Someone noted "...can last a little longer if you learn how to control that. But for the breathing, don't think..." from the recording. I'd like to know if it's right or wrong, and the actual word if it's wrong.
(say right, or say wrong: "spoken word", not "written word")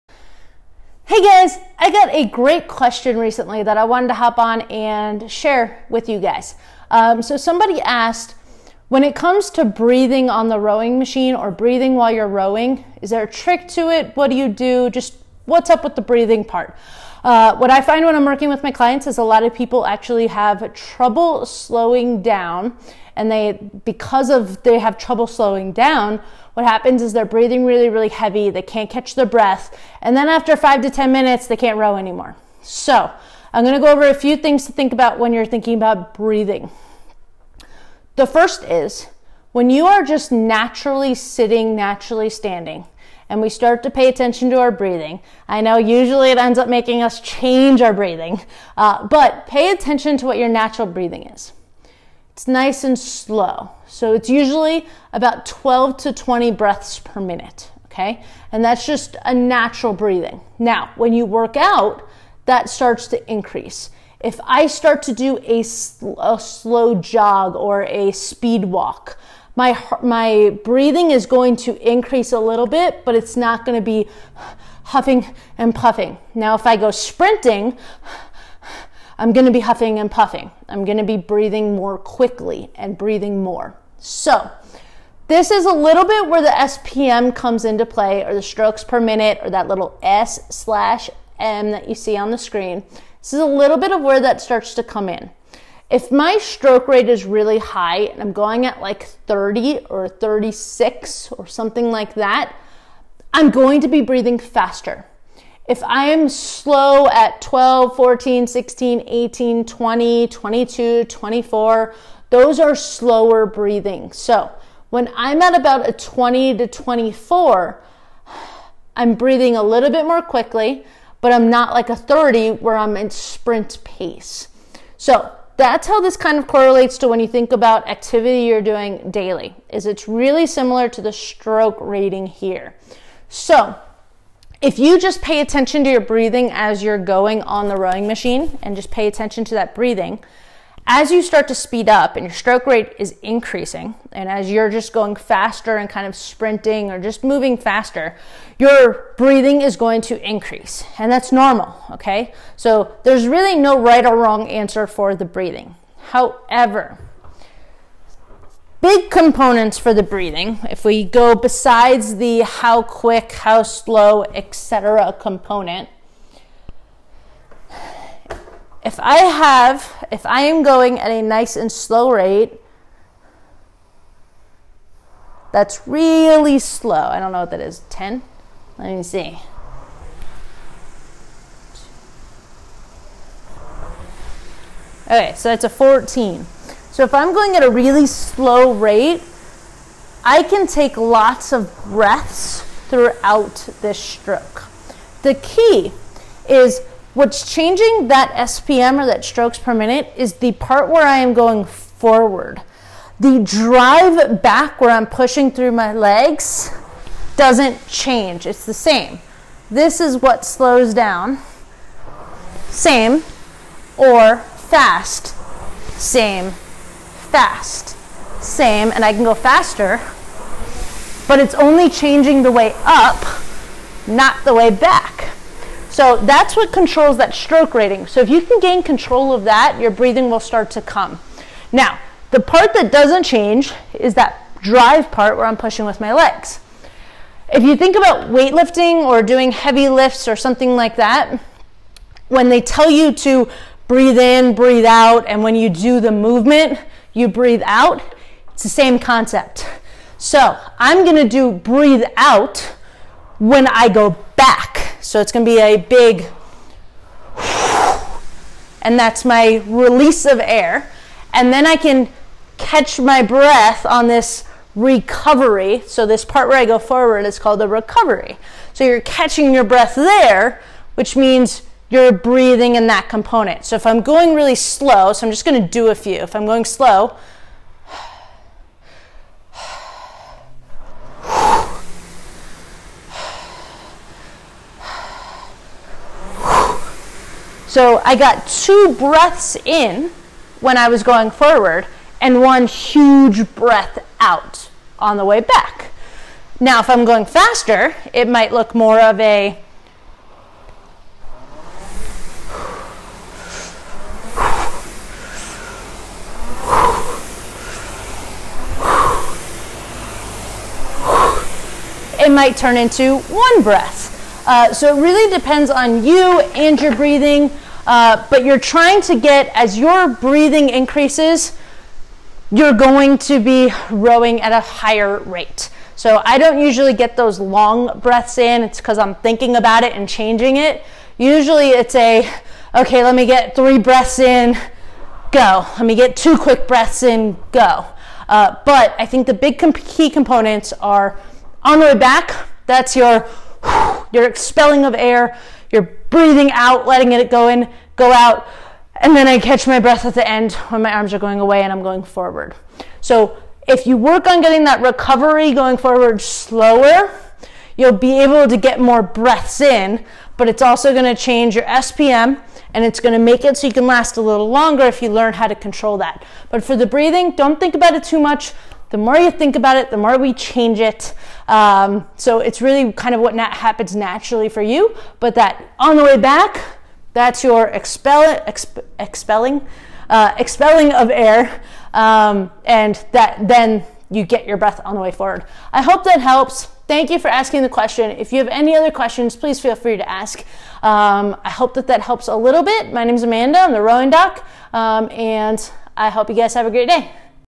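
right.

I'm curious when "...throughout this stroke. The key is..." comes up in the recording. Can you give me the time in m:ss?
3:12.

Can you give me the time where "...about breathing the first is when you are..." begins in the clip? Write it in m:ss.
0:35.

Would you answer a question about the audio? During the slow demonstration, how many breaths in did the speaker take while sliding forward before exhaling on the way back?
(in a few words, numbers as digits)
2.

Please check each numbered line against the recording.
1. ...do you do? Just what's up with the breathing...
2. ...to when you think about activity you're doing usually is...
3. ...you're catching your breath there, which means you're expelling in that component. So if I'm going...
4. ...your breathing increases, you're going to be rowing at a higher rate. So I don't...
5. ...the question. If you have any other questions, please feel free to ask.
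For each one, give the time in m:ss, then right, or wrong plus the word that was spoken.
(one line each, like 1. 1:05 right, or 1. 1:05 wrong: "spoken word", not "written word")
1. 0:14 right
2. 2:06 wrong: "daily", not "usually"
3. 4:28 wrong: "breathing", not "expelling"
4. 5:19 right
5. 6:27 right.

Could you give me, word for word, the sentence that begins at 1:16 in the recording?
Now, if I go sprinting, I'm going to be huffing and puffing.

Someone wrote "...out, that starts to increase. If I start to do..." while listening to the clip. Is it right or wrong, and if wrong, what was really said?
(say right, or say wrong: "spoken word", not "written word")
right.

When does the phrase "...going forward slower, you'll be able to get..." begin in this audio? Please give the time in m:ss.
5:55.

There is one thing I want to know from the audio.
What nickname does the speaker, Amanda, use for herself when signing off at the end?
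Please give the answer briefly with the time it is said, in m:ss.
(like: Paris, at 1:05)
the rowing doc, at 6:33.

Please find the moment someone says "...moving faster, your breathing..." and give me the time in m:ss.
2:27.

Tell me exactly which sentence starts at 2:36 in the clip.
However, big components for the breathing, if we go besides the how quick, how slow, etc.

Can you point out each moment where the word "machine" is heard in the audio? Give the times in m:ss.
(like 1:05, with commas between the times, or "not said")
0:10, 2:18.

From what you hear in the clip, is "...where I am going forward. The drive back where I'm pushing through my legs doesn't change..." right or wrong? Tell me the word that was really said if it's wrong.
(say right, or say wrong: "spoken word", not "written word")
right.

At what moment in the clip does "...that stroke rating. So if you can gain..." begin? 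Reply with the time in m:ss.
3:47.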